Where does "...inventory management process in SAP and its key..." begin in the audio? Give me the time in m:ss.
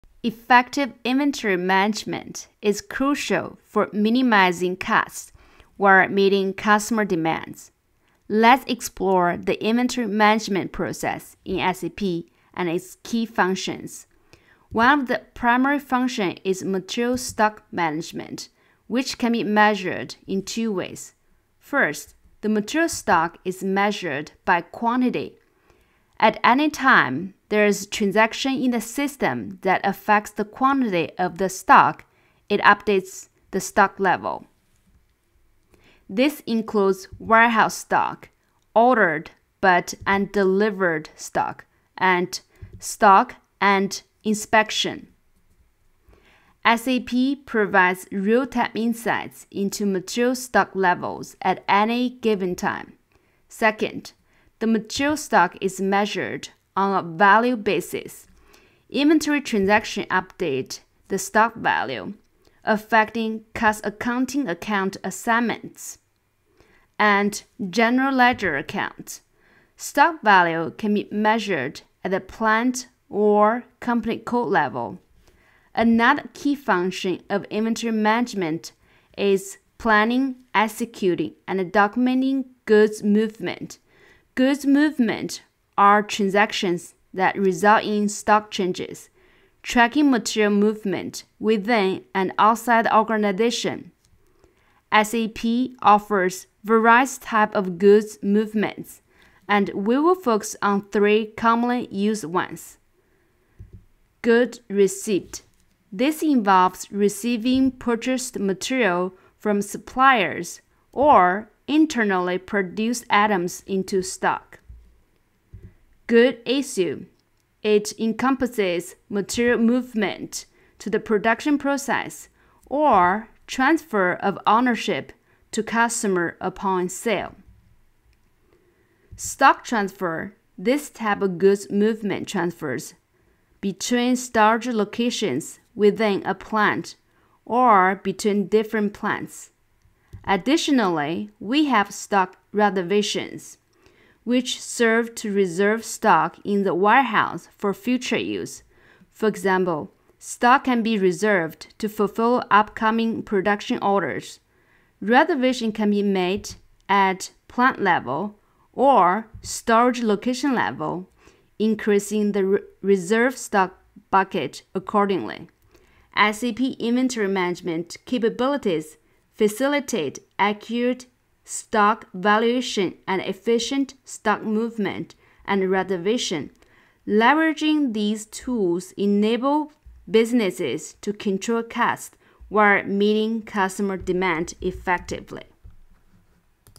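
0:09.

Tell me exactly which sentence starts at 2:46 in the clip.
SAP inventory management capabilities facilitate accurate stock valuation and efficient stock movement and reservation.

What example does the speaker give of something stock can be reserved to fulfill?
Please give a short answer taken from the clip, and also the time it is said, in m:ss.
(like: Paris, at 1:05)
upcoming production orders, at 2:32.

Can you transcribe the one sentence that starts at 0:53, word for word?
Second, the material stock is measured on a value basis.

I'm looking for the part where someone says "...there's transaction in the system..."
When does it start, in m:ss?
0:27.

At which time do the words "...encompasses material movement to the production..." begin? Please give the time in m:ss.
1:57.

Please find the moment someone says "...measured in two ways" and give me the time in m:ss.
0:19.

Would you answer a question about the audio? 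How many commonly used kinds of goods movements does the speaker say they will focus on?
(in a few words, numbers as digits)
3.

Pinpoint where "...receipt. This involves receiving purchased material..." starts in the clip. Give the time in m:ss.
1:44.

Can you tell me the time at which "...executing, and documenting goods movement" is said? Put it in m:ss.
1:20.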